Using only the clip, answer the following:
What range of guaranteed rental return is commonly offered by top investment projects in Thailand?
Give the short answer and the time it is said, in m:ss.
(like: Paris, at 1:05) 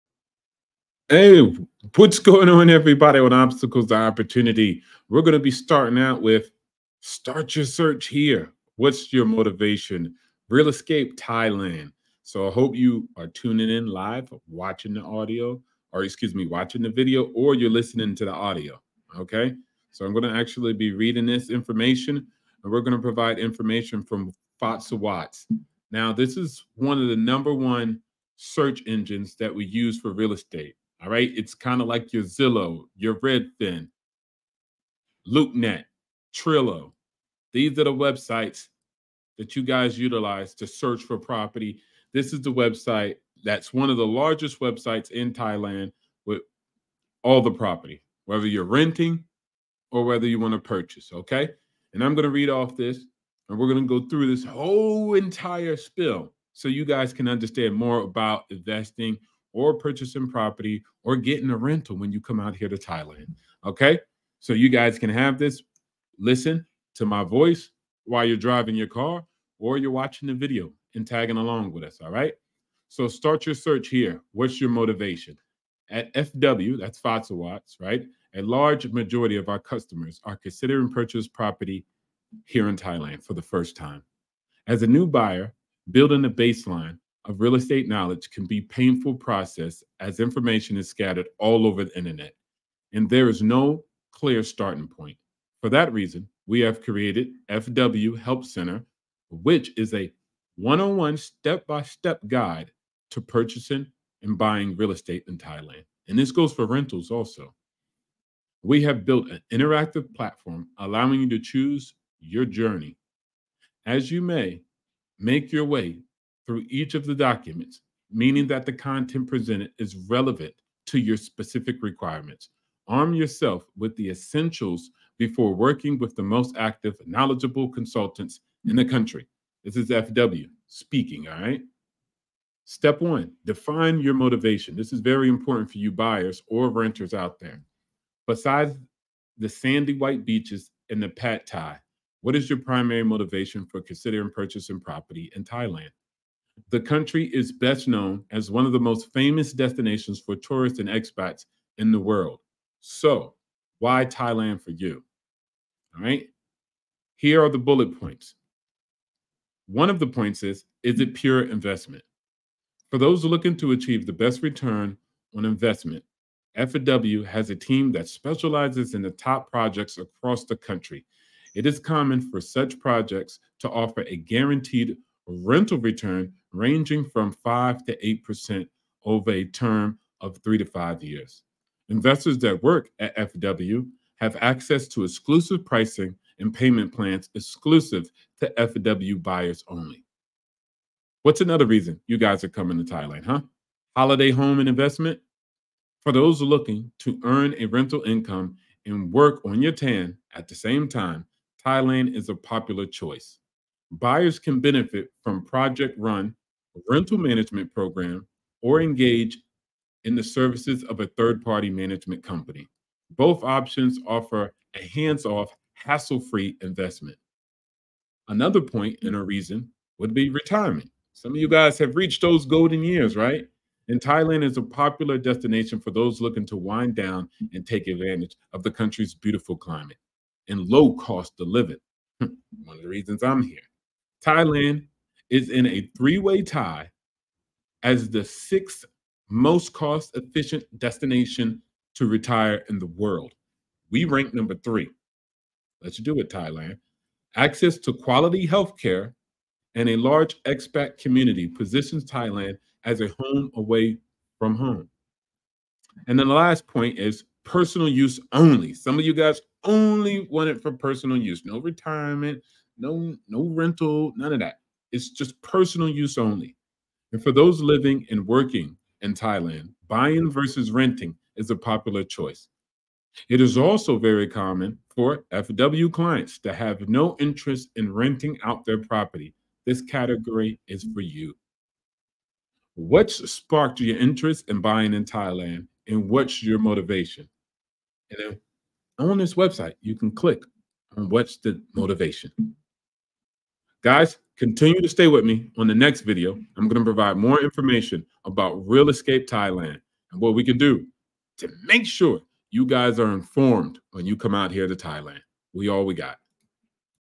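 5 to 8%, at 2:57.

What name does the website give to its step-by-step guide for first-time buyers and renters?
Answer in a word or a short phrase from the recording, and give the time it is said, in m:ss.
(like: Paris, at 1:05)
FW Help Center, at 1:37.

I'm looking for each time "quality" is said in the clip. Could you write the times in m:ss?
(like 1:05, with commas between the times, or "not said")
4:07.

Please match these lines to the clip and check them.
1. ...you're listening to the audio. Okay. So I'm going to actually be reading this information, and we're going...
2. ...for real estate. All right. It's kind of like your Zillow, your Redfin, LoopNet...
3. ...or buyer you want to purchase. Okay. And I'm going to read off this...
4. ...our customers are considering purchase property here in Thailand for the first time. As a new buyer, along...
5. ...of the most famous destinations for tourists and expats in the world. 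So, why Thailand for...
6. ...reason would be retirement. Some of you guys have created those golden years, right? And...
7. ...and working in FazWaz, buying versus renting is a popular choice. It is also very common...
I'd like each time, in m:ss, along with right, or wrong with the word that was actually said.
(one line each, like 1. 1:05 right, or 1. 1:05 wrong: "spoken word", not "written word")
1. 0:17 right
2. 0:29 right
3. 0:49 wrong: "whether", not "buyer"
4. 1:19 wrong: "building", not "along"
5. 2:28 right
6. 3:39 wrong: "reached", not "created"
7. 4:28 wrong: "Thailand", not "FazWaz".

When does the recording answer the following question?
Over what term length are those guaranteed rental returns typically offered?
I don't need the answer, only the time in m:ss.
3:00.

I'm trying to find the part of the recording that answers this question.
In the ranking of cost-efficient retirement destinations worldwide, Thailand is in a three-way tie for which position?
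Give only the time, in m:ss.
3:58.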